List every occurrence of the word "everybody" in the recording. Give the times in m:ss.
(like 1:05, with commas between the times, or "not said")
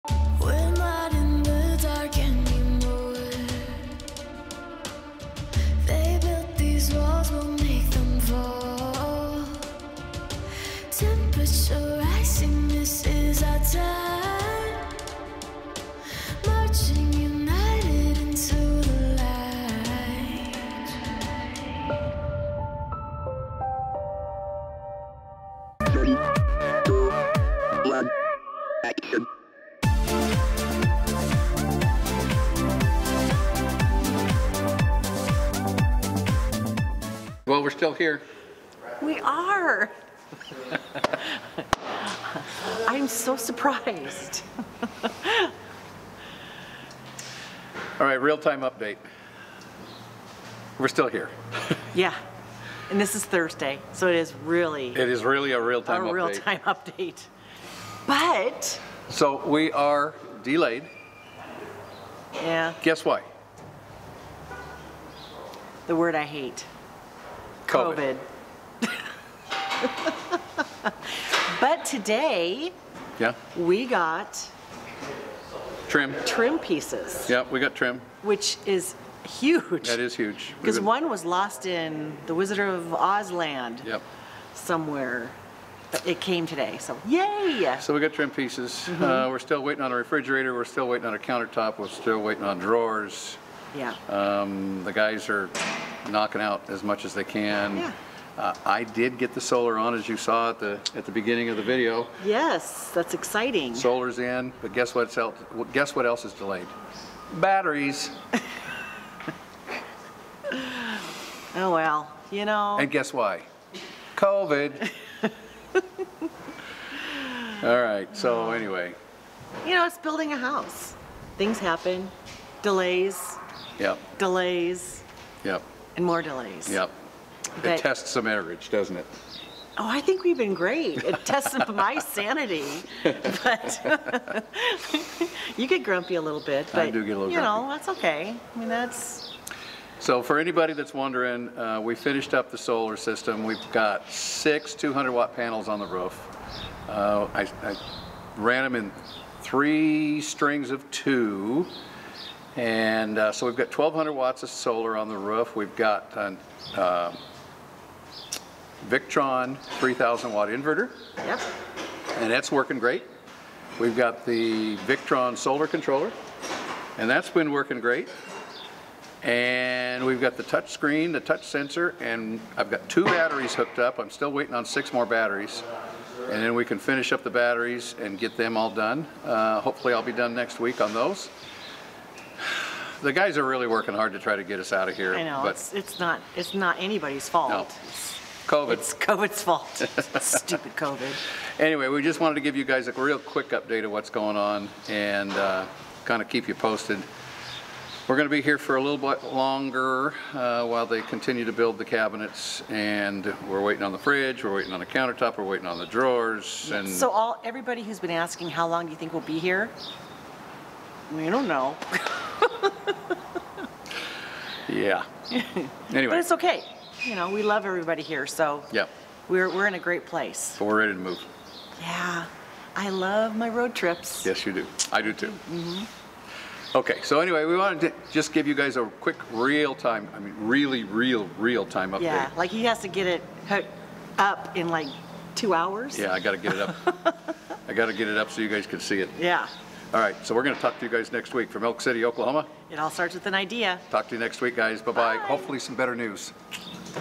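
3:27, 3:37.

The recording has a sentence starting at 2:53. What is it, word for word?
I'm still waiting on six more batteries.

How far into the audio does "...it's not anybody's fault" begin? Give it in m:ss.
3:06.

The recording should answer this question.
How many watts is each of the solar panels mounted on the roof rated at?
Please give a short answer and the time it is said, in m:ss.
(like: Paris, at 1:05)
200, at 2:24.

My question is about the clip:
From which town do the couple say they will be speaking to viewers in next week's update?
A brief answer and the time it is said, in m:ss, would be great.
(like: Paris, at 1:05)
Elk City, Oklahoma, at 4:01.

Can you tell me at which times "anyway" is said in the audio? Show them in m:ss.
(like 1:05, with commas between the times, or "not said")
1:58, 3:11, 3:35, 3:47.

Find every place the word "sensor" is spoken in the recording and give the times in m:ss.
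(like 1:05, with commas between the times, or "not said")
2:51.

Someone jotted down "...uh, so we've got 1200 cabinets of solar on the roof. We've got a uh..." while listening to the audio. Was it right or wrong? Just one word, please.
wrong.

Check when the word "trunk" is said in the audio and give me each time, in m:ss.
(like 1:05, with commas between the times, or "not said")
not said.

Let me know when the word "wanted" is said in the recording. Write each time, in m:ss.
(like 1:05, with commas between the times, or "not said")
3:12, 3:47.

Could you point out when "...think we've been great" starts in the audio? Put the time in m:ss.
2:10.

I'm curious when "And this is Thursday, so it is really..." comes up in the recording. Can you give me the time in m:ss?
0:52.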